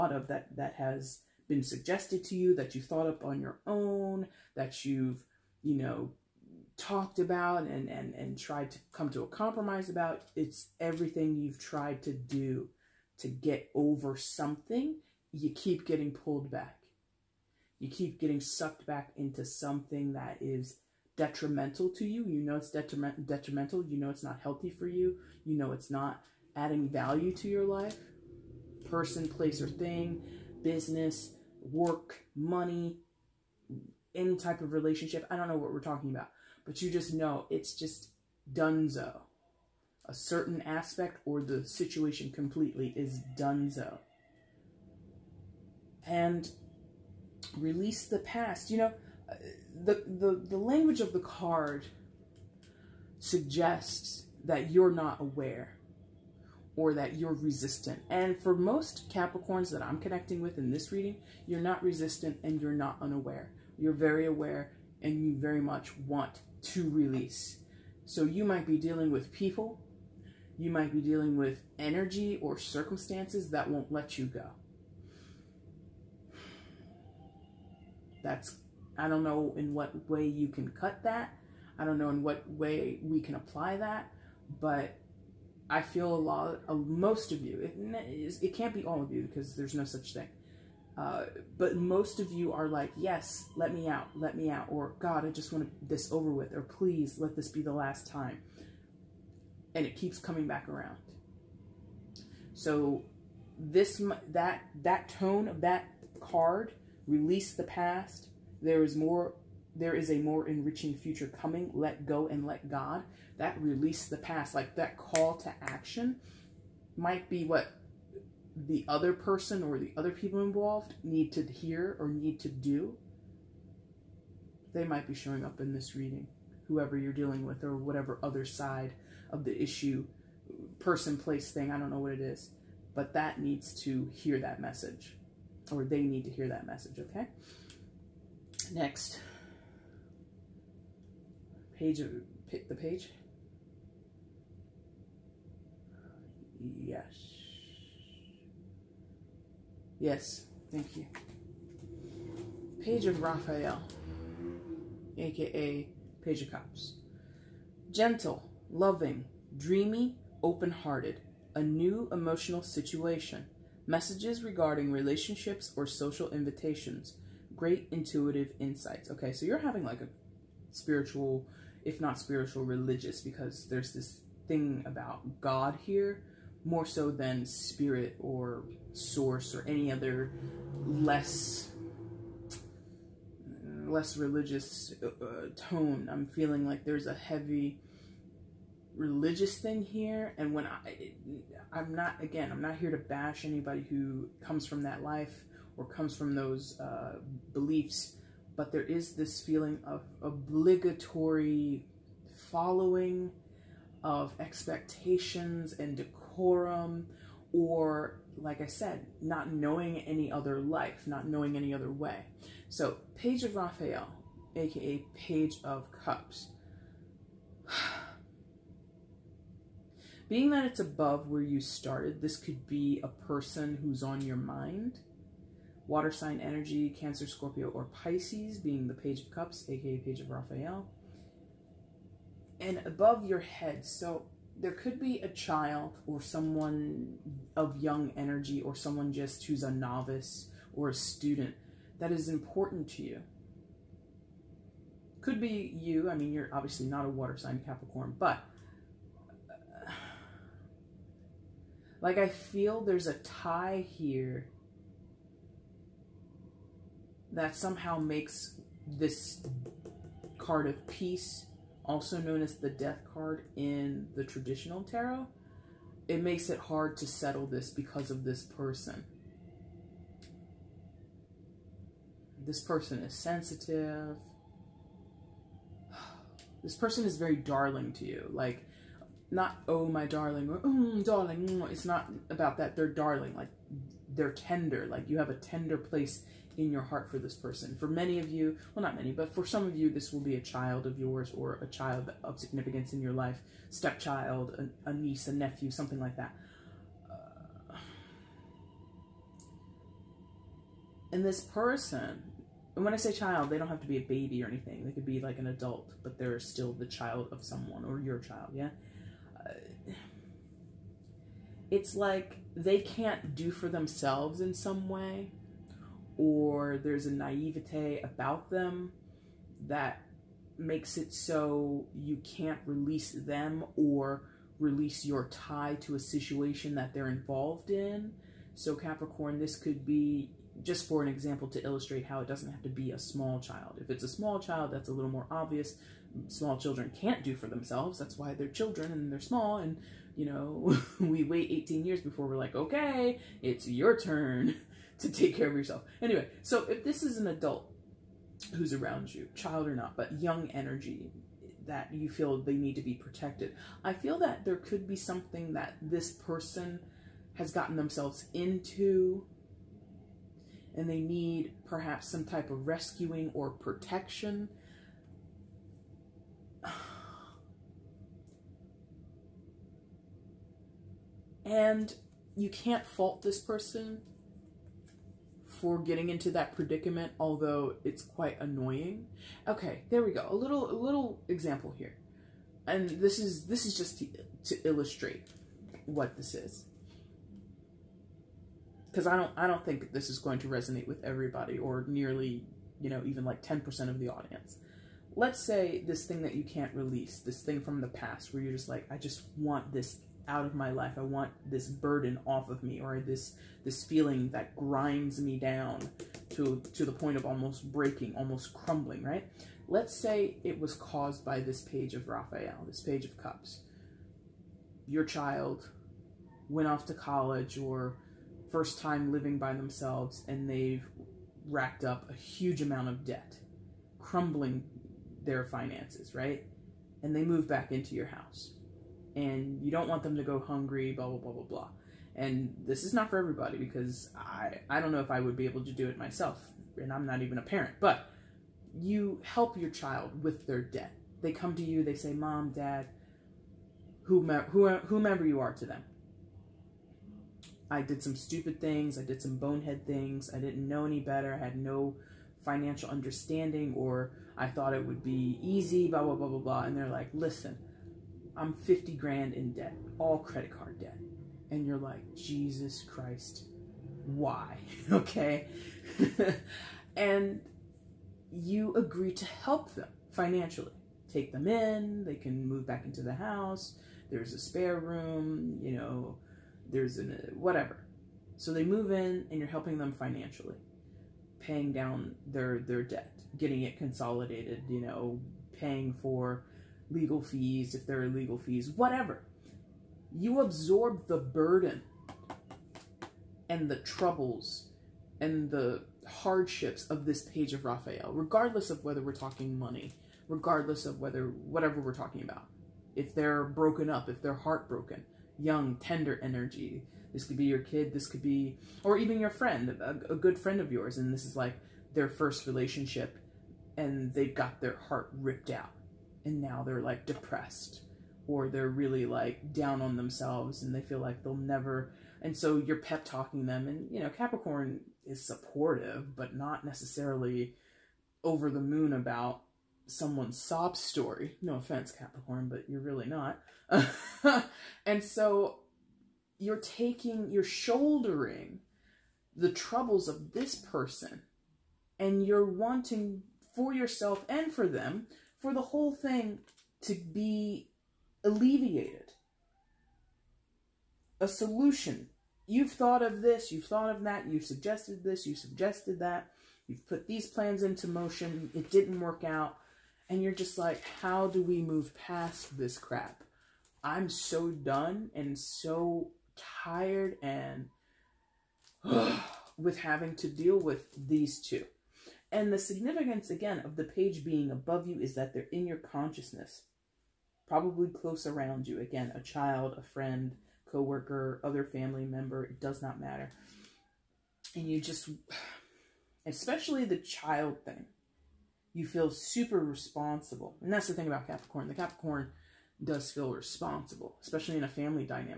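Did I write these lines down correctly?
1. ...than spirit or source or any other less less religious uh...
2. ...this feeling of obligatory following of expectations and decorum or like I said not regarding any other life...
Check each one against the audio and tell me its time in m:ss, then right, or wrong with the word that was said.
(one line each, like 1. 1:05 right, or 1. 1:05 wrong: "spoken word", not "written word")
1. 2:57 right
2. 3:19 wrong: "knowing", not "regarding".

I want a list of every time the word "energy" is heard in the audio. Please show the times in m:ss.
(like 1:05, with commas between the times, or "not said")
1:11, 3:46, 3:58, 5:50, 8:26.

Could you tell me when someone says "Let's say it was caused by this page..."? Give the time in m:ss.
6:49.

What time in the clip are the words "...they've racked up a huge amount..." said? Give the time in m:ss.
7:00.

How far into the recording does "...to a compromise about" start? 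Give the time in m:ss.
0:09.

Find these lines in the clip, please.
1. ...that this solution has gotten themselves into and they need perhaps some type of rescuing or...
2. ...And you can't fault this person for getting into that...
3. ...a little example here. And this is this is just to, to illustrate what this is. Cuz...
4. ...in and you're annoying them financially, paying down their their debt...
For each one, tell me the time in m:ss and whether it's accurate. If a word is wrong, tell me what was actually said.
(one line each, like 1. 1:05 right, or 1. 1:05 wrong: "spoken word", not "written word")
1. 5:55 wrong: "person", not "solution"
2. 6:11 right
3. 6:20 right
4. 7:58 wrong: "helping", not "annoying".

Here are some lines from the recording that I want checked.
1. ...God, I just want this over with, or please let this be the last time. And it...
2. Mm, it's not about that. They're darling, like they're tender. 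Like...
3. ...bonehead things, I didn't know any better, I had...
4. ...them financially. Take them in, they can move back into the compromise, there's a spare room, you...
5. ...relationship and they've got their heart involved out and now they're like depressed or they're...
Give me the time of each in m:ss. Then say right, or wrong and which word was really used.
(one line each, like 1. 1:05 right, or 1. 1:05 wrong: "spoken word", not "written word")
1. 1:34 right
2. 4:41 right
3. 7:29 right
4. 7:49 wrong: "house", not "compromise"
5. 8:32 wrong: "ripped", not "involved".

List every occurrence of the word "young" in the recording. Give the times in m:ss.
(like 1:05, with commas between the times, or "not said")
3:57, 5:50, 8:25.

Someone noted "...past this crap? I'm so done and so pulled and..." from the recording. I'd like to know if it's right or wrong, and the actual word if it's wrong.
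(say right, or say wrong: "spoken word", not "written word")
wrong: "tired", not "pulled".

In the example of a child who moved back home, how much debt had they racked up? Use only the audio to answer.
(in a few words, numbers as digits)
50 grand.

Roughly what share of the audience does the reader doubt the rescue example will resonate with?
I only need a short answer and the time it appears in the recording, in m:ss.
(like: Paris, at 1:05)
10%, at 6:33.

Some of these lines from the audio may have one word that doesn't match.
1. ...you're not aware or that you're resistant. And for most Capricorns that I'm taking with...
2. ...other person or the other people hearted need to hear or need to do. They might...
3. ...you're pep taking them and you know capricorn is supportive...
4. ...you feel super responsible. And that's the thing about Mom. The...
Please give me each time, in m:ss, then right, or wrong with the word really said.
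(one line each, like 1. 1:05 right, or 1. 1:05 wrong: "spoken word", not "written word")
1. 0:54 wrong: "connecting", not "taking"
2. 1:58 wrong: "involved", not "hearted"
3. 8:42 wrong: "talking", not "taking"
4. 9:48 wrong: "Capricorn", not "Mom".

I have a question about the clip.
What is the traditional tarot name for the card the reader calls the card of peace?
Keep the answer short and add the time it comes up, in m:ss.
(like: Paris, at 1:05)
Death card, at 4:22.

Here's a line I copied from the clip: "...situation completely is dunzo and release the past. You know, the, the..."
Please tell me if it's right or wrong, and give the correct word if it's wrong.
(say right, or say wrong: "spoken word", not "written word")
right.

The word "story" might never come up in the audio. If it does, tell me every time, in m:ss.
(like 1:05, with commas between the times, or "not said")
8:50.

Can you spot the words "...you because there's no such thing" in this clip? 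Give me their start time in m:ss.
1:29.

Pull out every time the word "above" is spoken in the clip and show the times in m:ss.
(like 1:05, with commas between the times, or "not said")
3:40, 3:52, 9:34.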